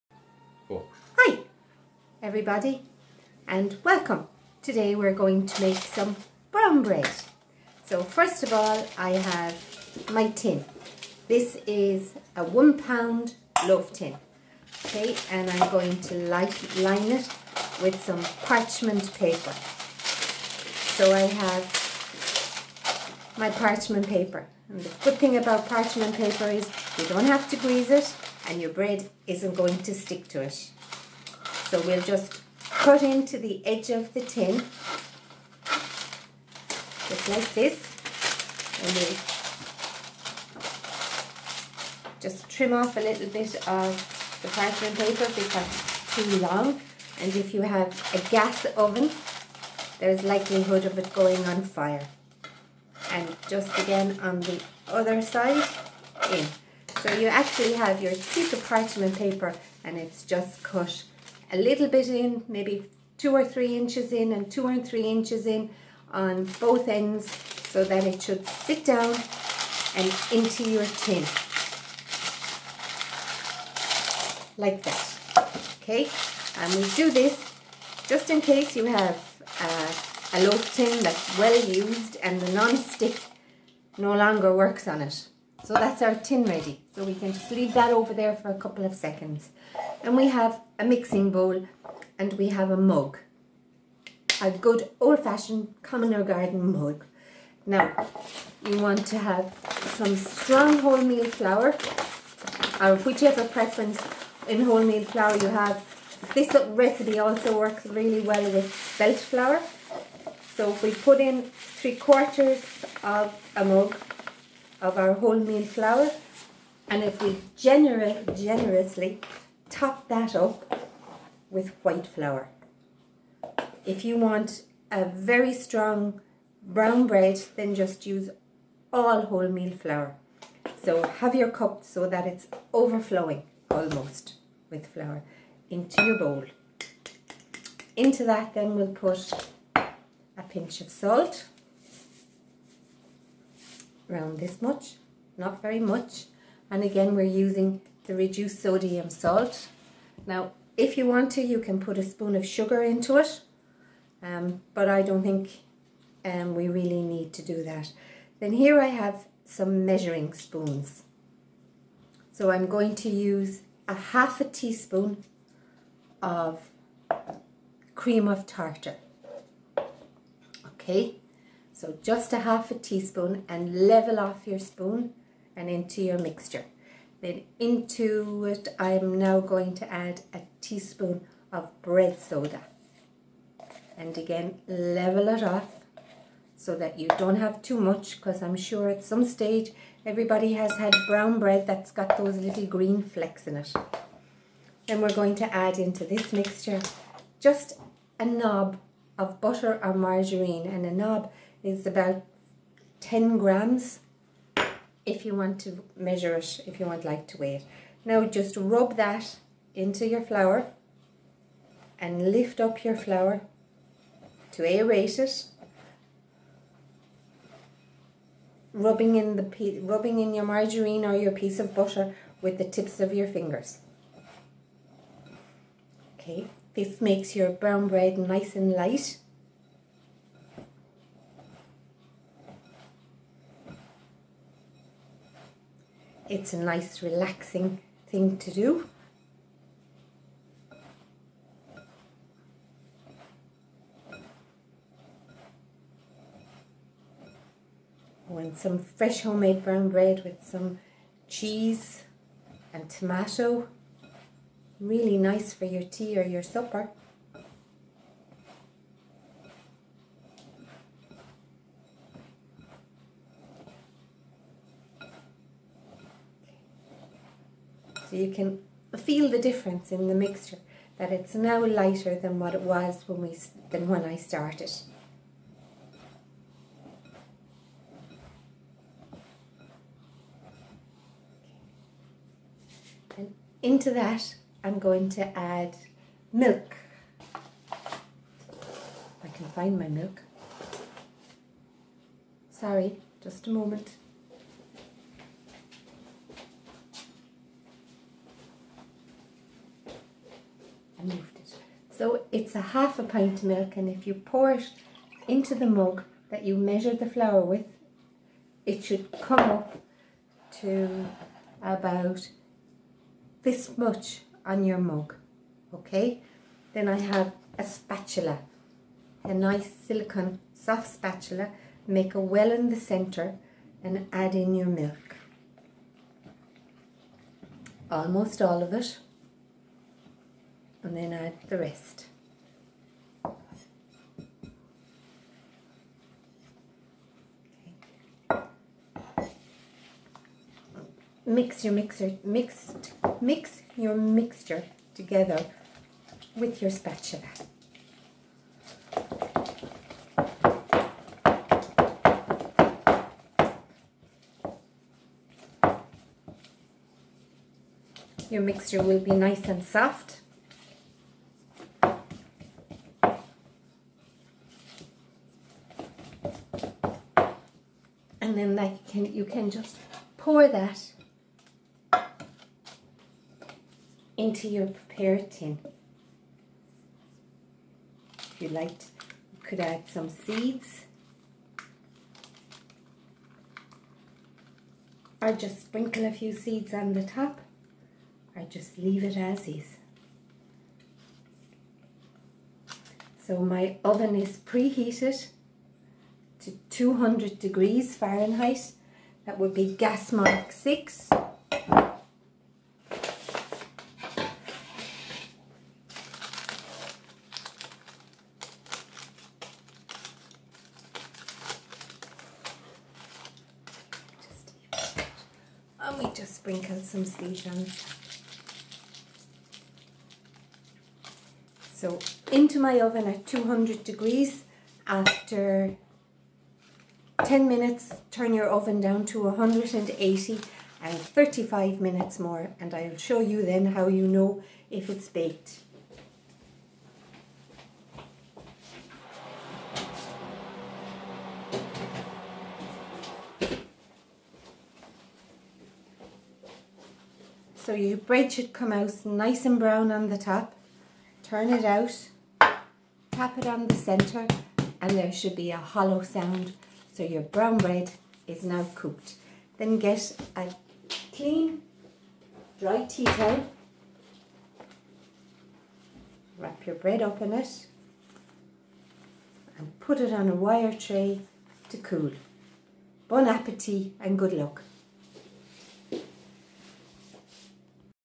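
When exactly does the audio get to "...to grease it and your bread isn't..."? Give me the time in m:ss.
0:27.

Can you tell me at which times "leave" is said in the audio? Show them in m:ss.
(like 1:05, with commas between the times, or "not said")
1:27, 6:28.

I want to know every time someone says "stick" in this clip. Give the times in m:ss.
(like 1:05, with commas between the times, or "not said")
0:29, 1:22.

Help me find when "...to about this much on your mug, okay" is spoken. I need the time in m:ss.
5:10.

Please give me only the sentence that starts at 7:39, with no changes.
Then get a clean, dry tea towel.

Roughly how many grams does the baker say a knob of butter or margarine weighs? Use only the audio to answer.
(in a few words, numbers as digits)
10 grams.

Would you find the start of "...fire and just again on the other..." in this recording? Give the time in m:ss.
0:51.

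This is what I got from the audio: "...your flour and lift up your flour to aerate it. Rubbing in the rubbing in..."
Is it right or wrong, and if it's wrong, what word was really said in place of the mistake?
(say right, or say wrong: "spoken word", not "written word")
right.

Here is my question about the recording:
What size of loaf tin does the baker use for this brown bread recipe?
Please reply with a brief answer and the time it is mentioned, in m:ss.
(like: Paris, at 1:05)
1 pound, at 0:12.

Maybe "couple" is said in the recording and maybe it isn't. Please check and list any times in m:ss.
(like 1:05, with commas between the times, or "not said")
1:28.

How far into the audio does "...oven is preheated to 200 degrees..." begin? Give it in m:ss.
6:33.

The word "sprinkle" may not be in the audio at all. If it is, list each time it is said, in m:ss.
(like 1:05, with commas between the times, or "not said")
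6:25, 6:56.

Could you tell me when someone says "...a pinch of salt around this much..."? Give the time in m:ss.
2:19.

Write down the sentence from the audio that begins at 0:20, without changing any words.
So I have my parchment paper.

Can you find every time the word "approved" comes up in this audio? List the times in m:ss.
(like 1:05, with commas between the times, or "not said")
not said.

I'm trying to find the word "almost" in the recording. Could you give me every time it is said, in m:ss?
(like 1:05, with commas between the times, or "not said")
2:13, 5:27.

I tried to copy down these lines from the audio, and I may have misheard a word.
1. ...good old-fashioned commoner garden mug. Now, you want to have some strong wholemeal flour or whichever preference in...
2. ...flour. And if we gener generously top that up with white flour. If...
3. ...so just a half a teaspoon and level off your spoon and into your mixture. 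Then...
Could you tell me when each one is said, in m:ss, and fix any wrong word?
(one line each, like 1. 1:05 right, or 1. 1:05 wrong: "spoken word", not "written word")
1. 1:34 right
2. 1:55 right
3. 2:51 right.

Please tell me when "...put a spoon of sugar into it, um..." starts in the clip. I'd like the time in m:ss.
2:31.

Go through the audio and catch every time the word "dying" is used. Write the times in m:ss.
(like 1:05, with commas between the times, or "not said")
not said.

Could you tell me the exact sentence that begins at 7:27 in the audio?
So your bread should come out nice and brown on the top.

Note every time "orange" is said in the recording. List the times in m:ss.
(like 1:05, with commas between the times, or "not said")
not said.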